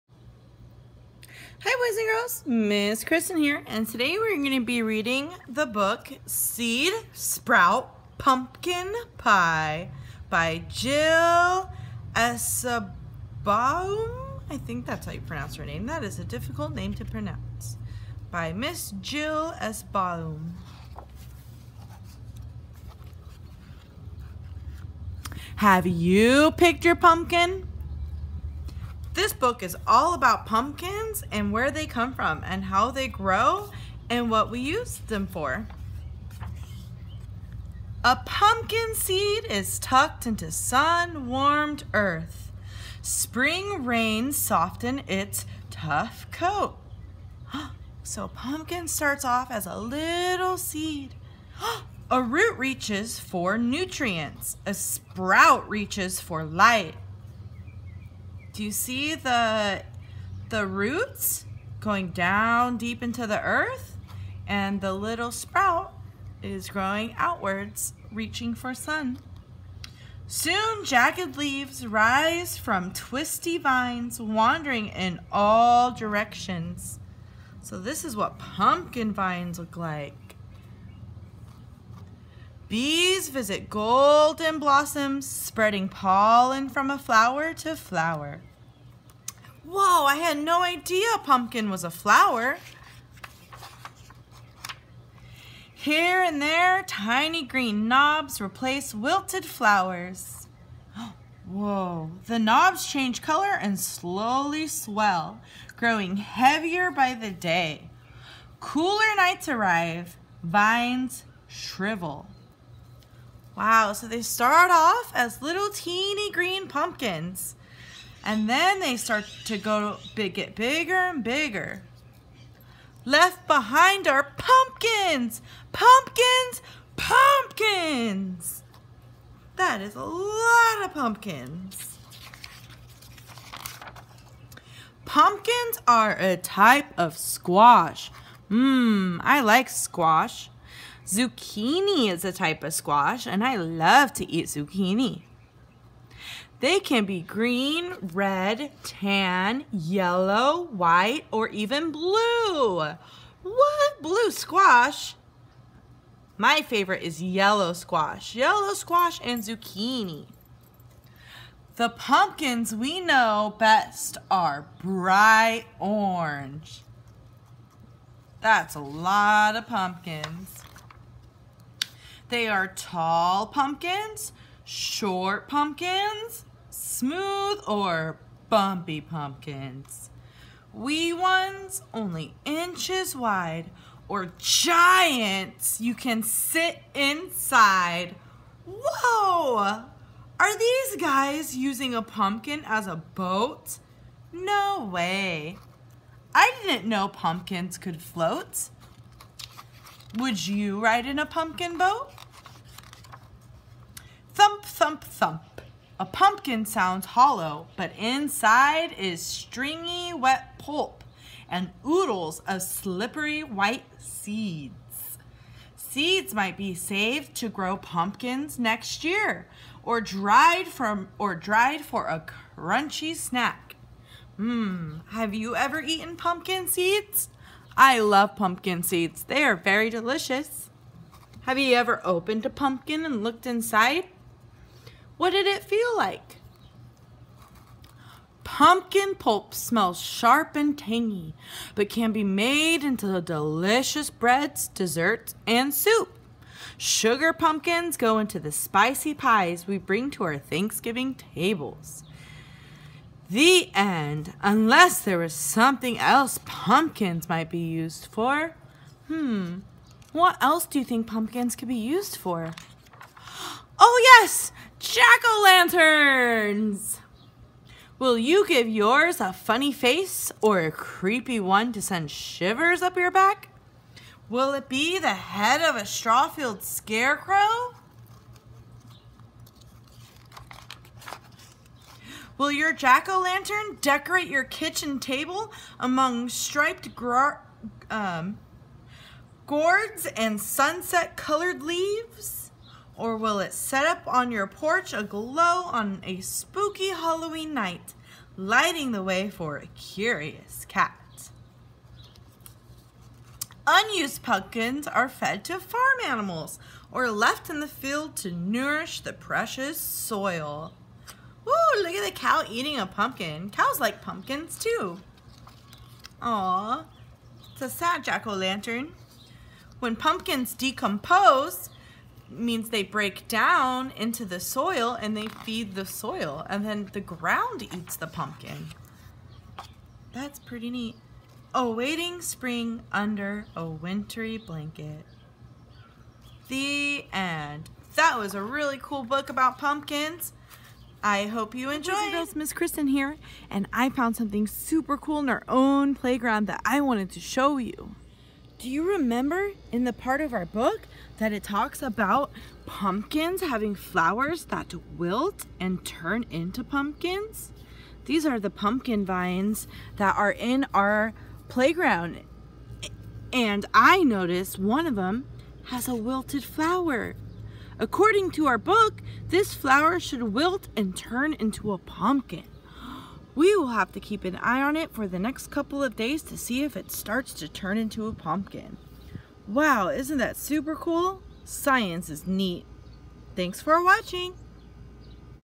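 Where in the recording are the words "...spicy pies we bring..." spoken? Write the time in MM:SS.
04:08.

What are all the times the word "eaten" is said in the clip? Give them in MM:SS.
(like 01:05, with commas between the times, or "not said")
03:45.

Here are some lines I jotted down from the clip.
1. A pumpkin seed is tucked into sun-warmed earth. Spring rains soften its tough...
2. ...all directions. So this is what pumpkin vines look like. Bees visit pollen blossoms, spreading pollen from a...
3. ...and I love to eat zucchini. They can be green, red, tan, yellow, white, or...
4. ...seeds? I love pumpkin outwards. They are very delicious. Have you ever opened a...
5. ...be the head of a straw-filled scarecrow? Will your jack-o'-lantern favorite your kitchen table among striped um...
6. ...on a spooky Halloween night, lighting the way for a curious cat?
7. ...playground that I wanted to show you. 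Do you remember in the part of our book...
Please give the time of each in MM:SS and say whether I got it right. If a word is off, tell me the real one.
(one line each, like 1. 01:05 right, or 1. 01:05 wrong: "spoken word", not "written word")
1. 00:38 right
2. 01:15 wrong: "golden", not "pollen"
3. 02:23 right
4. 03:46 wrong: "seeds", not "outwards"
5. 04:34 wrong: "decorate", not "favorite"
6. 04:55 right
7. 05:45 right.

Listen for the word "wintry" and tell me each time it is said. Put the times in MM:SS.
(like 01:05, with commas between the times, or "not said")
05:33.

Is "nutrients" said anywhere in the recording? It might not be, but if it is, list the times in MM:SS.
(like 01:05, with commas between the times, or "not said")
00:53.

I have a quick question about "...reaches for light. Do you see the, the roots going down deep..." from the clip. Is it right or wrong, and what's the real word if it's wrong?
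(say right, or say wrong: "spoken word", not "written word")
right.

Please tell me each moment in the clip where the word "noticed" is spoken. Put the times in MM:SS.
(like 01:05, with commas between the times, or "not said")
06:04.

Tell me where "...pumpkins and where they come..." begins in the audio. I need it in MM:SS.
00:30.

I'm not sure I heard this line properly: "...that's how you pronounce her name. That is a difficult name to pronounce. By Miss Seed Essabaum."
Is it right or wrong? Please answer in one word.
wrong.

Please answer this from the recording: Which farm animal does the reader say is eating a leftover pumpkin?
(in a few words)
Cow.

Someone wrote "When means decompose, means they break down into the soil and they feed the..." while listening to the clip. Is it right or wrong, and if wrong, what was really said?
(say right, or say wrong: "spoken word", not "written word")
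wrong: "pumpkins", not "means".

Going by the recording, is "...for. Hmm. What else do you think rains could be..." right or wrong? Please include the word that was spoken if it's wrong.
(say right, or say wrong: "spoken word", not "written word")
wrong: "pumpkins", not "rains".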